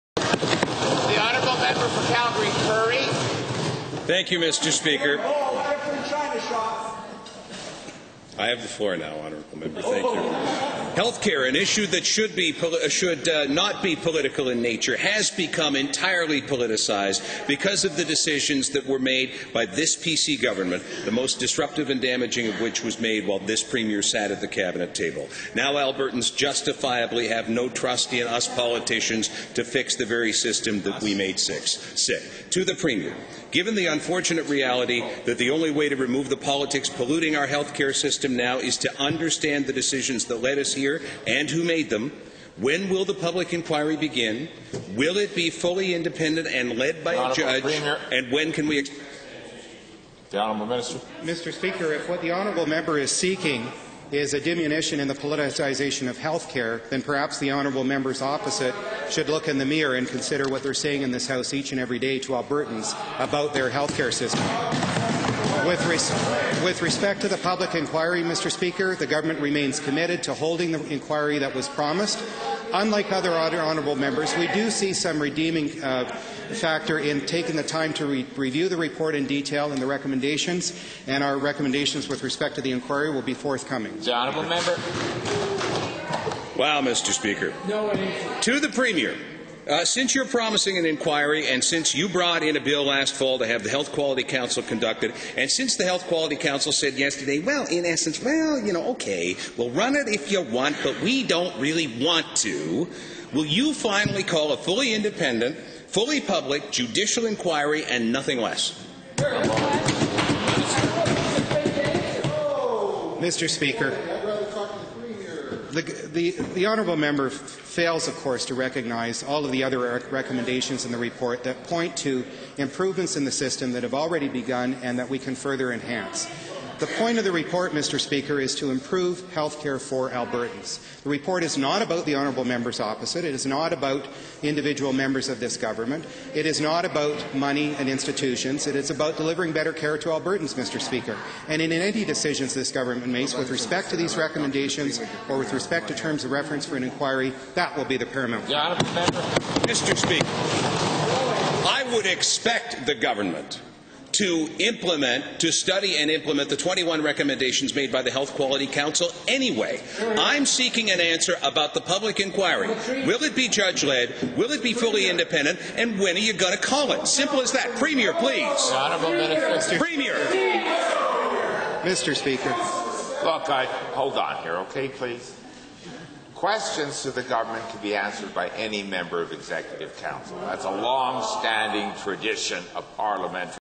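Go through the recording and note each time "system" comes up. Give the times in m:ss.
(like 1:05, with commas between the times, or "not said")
0:30, 0:37, 1:04, 2:03.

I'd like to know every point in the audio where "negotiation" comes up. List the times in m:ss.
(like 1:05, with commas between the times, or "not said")
not said.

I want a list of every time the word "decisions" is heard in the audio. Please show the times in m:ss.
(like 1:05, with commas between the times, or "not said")
0:18, 0:39, 2:22.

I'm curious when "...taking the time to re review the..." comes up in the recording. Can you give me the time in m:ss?
1:17.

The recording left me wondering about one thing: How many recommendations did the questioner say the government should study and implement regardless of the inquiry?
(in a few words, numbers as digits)
21.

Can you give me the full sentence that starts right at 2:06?
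The point of the report, Mr.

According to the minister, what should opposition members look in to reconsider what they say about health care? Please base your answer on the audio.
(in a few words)
the mirror.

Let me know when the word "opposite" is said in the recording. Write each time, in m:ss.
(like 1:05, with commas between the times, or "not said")
0:58, 2:12.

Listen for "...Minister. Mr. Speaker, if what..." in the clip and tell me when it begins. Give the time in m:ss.
0:50.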